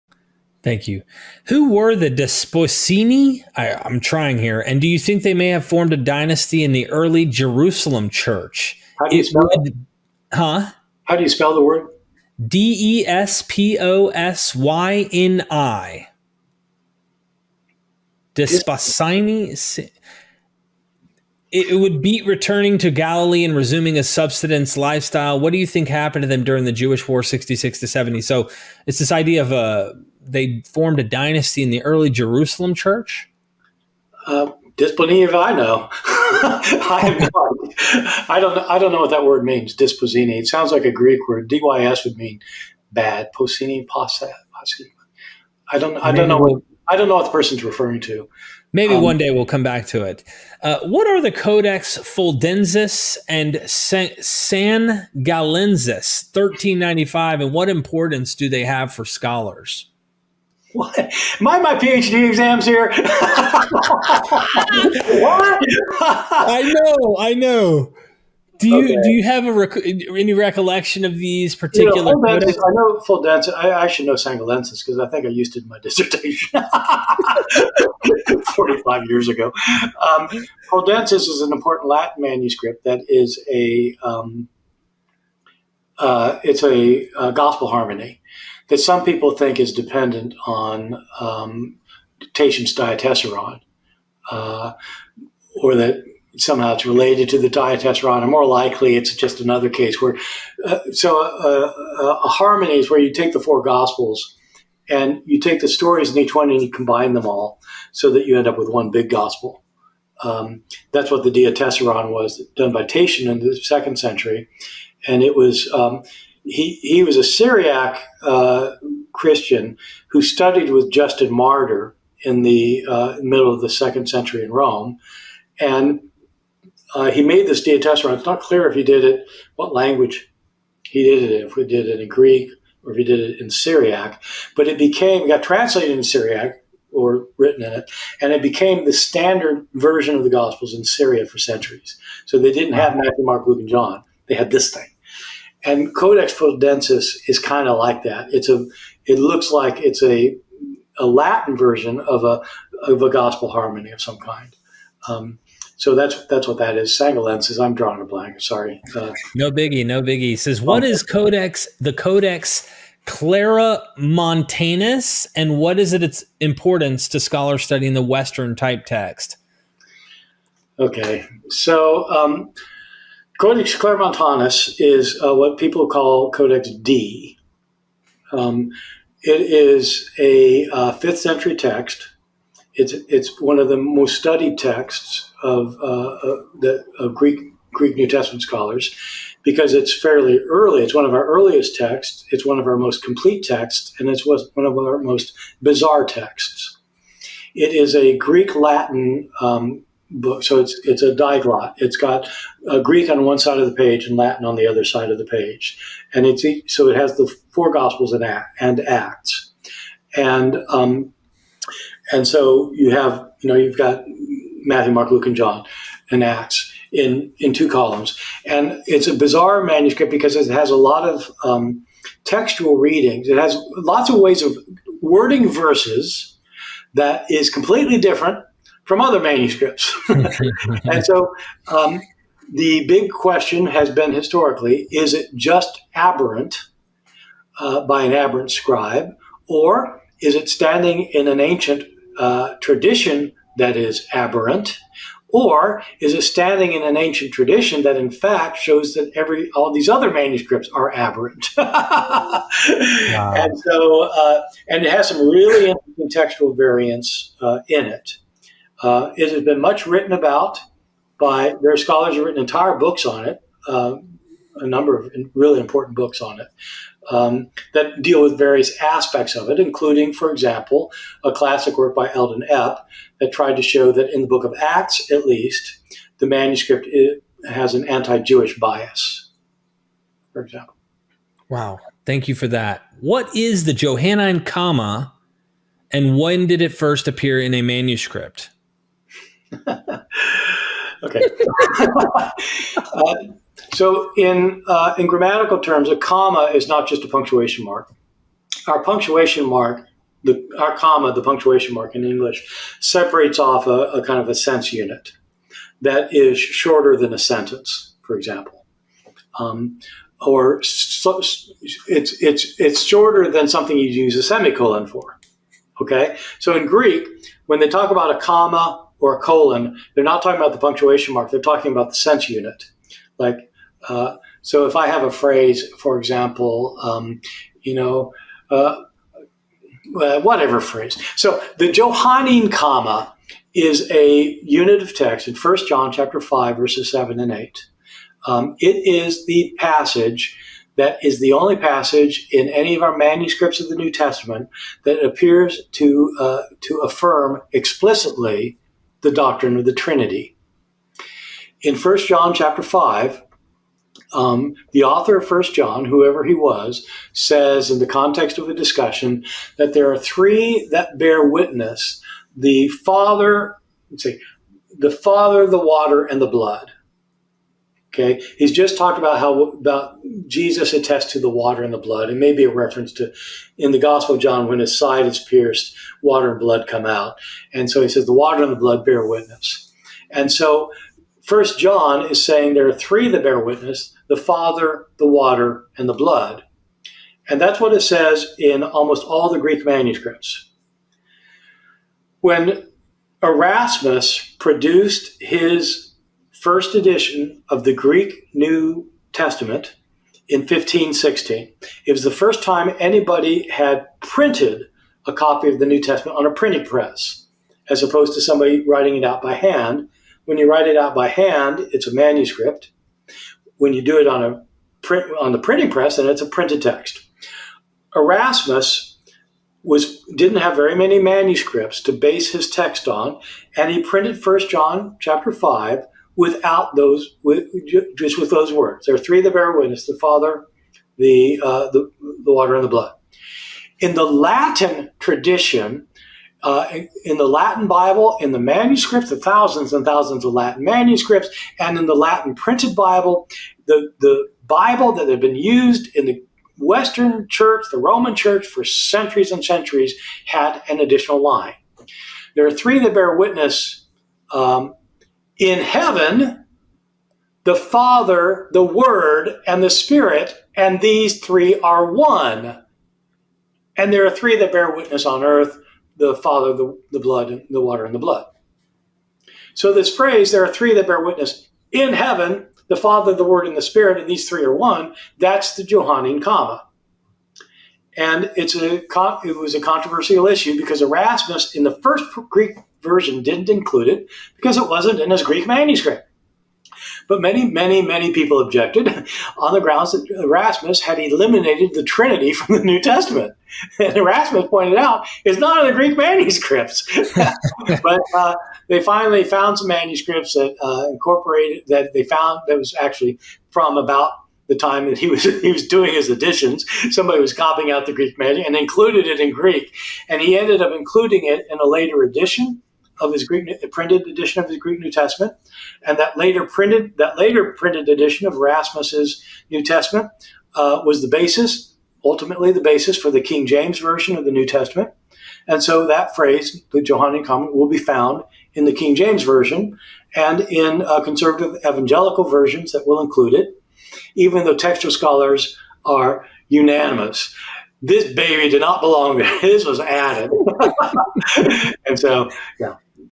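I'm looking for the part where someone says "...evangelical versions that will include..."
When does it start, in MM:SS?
08:51.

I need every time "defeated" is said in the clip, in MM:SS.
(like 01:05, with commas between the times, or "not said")
not said.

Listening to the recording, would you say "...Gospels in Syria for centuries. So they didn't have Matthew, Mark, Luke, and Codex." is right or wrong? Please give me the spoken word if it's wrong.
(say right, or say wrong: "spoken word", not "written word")
wrong: "John", not "Codex".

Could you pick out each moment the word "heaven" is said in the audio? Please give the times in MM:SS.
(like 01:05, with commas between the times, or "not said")
07:35, 07:51.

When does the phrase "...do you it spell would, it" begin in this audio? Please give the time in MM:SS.
00:09.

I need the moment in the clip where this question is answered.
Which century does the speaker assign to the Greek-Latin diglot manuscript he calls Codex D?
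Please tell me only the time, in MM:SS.
03:00.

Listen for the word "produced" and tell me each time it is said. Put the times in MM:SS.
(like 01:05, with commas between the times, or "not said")
06:34.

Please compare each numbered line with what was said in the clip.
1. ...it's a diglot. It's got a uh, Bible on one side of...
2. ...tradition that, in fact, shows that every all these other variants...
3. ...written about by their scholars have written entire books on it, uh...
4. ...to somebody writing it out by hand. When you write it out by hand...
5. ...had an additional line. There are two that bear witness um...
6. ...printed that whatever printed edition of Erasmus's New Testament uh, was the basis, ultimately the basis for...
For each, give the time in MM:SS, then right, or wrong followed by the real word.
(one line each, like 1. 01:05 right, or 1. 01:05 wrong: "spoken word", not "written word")
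1. 03:20 wrong: "Greek", not "Bible"
2. 04:07 wrong: "manuscripts", not "variants"
3. 04:19 right
4. 06:48 right
5. 07:30 wrong: "three", not "two"
6. 08:36 wrong: "later", not "whatever".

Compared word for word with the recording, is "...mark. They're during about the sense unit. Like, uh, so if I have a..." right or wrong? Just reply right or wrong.
wrong.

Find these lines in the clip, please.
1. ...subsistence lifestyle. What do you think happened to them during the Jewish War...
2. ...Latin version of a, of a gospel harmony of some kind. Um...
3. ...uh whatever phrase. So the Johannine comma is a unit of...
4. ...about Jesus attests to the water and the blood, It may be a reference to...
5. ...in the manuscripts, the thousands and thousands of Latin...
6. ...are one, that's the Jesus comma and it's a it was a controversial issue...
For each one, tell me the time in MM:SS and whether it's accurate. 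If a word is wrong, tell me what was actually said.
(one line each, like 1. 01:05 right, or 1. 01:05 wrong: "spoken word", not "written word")
1. 00:24 right
2. 02:31 right
3. 05:29 right
4. 06:09 right
5. 07:18 right
6. 07:54 wrong: "Johannine", not "Jesus".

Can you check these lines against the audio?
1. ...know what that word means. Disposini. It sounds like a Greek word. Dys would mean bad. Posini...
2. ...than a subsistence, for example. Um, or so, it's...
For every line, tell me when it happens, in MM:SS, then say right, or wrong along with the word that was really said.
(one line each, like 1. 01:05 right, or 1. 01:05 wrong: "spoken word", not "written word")
1. 00:38 right
2. 05:06 wrong: "sentence", not "subsistence".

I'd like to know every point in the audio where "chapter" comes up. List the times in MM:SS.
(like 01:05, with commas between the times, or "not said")
05:35, 05:52, 07:04.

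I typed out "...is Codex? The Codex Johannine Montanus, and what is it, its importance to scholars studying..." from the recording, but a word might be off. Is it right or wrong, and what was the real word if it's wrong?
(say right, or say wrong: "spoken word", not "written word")
wrong: "Clara", not "Johannine".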